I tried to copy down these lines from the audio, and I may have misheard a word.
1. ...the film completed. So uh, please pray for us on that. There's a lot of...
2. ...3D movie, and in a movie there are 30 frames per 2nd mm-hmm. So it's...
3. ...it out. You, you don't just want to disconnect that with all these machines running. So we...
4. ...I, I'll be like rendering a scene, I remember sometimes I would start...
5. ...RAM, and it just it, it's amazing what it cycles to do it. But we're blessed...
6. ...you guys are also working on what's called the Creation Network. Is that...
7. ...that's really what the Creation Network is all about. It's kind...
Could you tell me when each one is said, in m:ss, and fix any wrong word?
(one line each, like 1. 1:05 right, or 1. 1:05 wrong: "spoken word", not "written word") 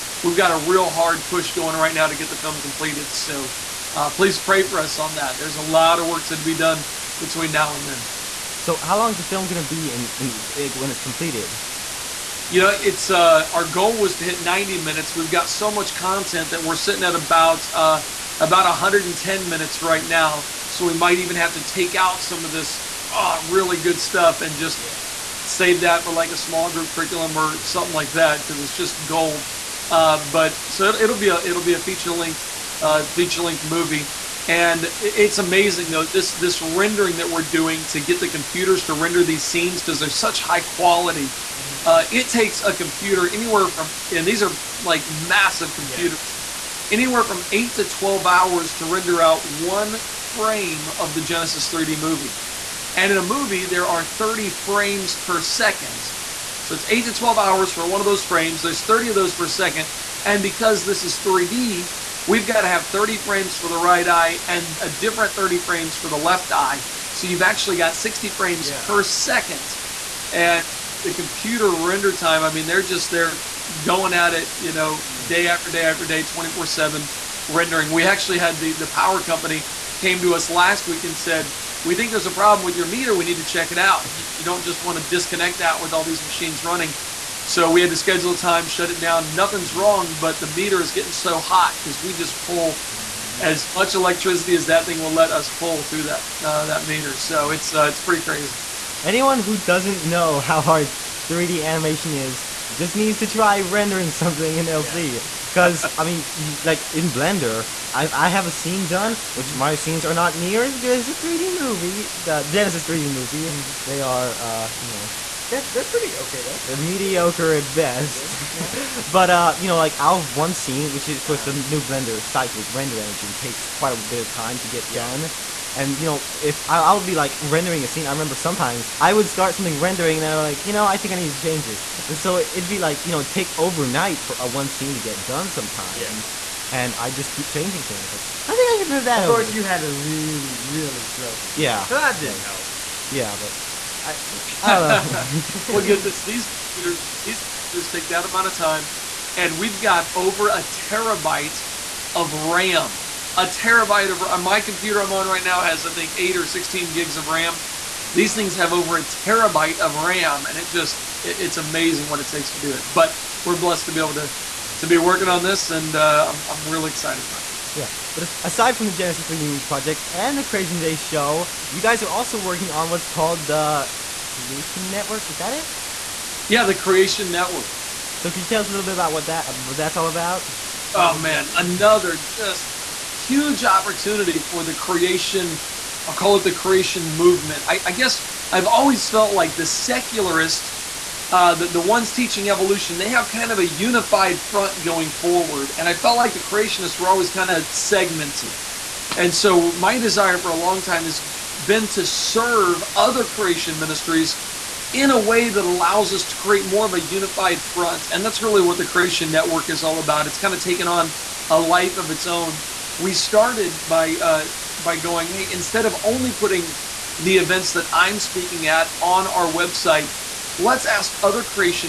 1. 0:02 right
2. 0:51 right
3. 1:23 right
4. 2:06 right
5. 2:39 wrong: "takes", not "cycles"
6. 2:51 right
7. 3:28 right.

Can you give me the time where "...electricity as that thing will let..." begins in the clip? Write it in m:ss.
1:33.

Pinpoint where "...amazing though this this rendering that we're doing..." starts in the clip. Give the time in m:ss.
0:35.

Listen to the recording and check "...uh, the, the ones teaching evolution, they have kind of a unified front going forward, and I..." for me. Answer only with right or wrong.
right.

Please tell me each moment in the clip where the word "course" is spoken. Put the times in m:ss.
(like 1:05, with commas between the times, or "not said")
2:19.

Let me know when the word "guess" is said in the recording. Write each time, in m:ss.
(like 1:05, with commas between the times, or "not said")
3:07.